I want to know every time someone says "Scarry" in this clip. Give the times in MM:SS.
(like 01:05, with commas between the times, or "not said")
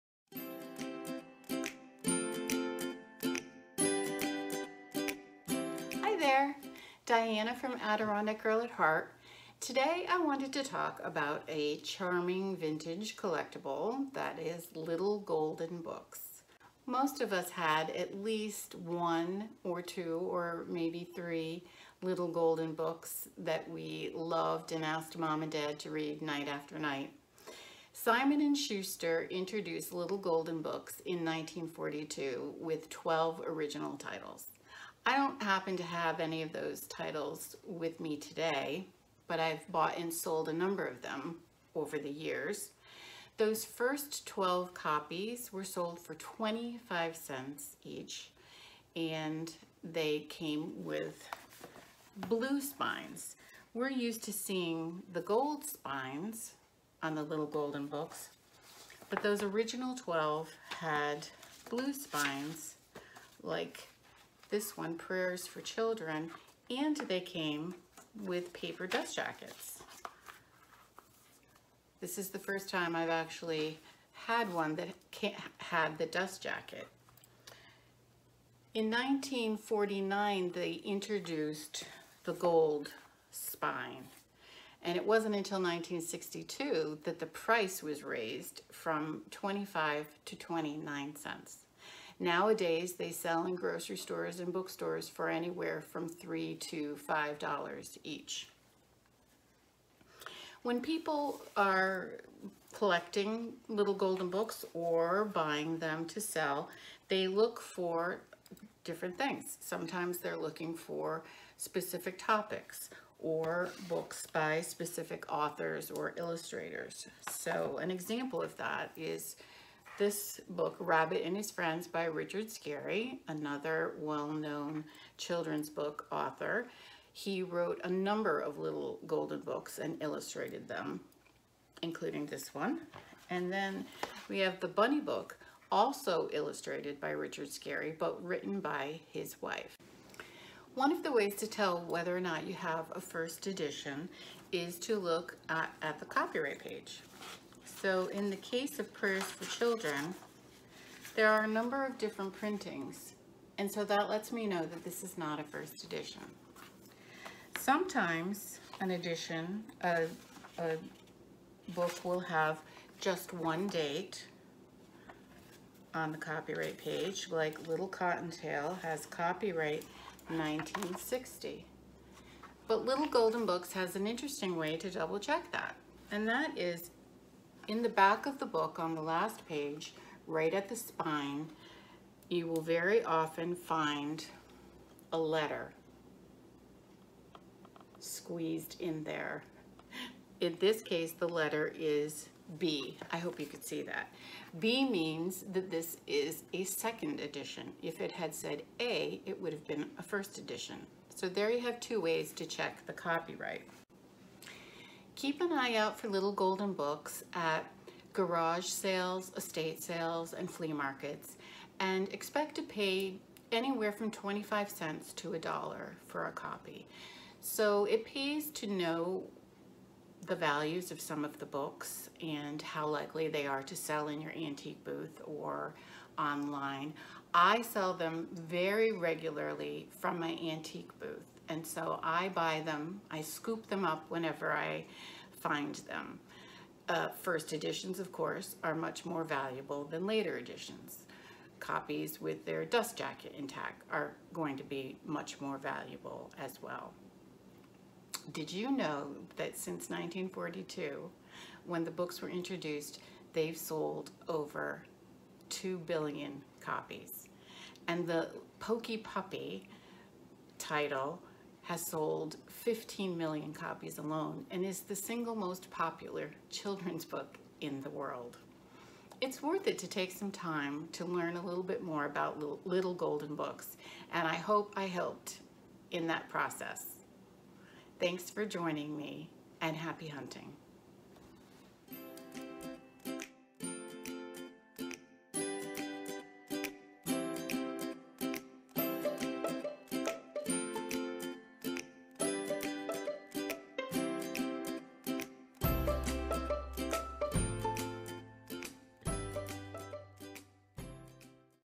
02:02, 02:17.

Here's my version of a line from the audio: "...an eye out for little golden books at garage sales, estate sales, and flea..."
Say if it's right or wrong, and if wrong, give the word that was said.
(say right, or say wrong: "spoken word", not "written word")
right.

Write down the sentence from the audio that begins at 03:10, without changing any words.
In this case, the letter is B.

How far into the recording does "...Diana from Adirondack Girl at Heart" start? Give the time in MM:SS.
00:07.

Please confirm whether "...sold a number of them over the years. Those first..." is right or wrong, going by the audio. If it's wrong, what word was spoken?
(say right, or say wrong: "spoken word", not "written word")
right.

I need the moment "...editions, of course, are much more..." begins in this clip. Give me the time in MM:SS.
03:57.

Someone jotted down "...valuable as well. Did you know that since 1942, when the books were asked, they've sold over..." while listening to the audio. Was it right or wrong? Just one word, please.
wrong.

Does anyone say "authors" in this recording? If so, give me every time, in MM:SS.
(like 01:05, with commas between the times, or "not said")
01:55, 02:06.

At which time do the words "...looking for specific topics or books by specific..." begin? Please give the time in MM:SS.
01:50.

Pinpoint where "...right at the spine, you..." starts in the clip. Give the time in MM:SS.
03:00.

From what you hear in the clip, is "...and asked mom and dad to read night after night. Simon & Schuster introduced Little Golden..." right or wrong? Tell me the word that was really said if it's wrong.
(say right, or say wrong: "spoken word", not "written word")
right.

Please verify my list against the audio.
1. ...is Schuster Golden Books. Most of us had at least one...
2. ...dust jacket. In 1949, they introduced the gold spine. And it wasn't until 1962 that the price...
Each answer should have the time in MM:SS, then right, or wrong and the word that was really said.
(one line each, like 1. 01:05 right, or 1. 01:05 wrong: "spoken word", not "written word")
1. 00:14 wrong: "Little", not "Schuster"
2. 01:16 right.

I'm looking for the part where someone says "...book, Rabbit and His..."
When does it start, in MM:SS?
02:00.